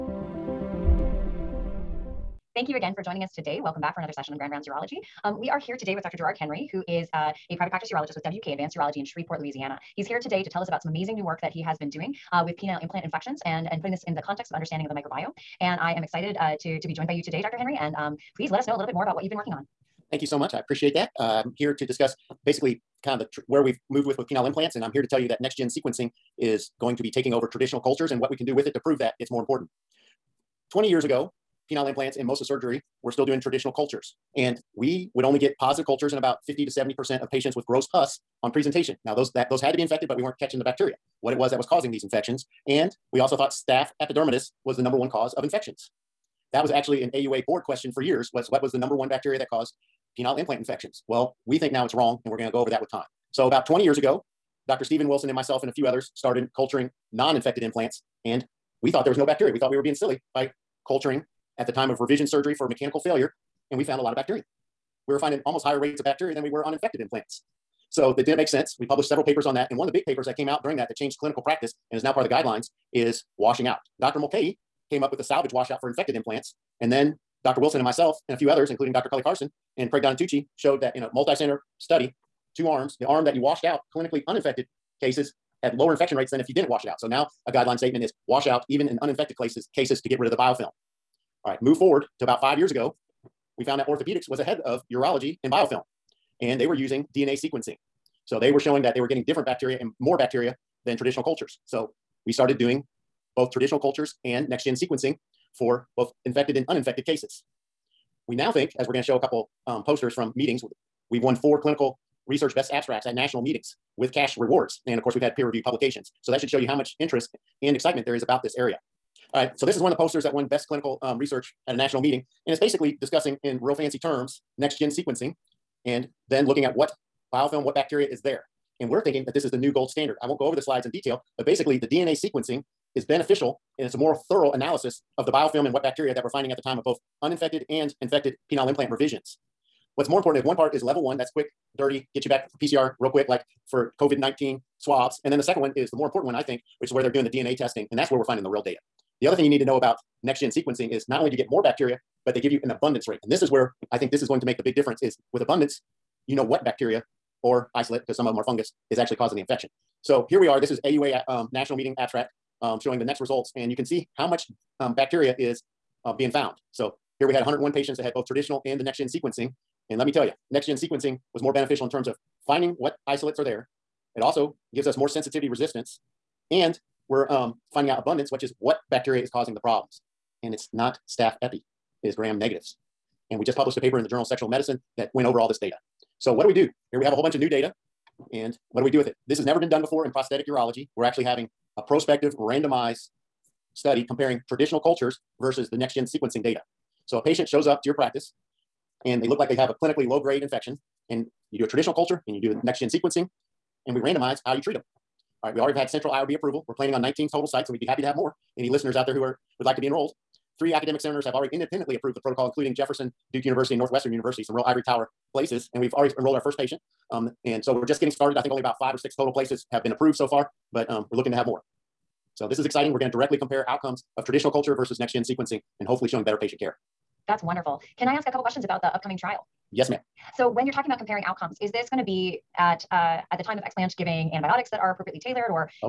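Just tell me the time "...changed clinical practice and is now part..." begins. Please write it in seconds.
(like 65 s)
70 s.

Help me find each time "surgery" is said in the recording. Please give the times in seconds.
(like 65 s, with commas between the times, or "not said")
32 s, 62 s.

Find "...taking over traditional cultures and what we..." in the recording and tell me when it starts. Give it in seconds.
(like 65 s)
27 s.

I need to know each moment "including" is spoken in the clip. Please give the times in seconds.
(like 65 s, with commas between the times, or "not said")
78 s, 212 s.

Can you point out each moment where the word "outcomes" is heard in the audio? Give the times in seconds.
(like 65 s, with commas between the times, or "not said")
223 s, 231 s.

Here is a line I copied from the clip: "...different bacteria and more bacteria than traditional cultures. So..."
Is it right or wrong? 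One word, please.
right.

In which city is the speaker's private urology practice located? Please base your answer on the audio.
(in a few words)
Shreveport.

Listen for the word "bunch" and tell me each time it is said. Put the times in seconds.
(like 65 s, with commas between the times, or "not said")
187 s.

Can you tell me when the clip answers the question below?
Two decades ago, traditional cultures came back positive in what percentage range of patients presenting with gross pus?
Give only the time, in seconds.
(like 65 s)
36 s.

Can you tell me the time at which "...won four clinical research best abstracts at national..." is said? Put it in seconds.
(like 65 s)
111 s.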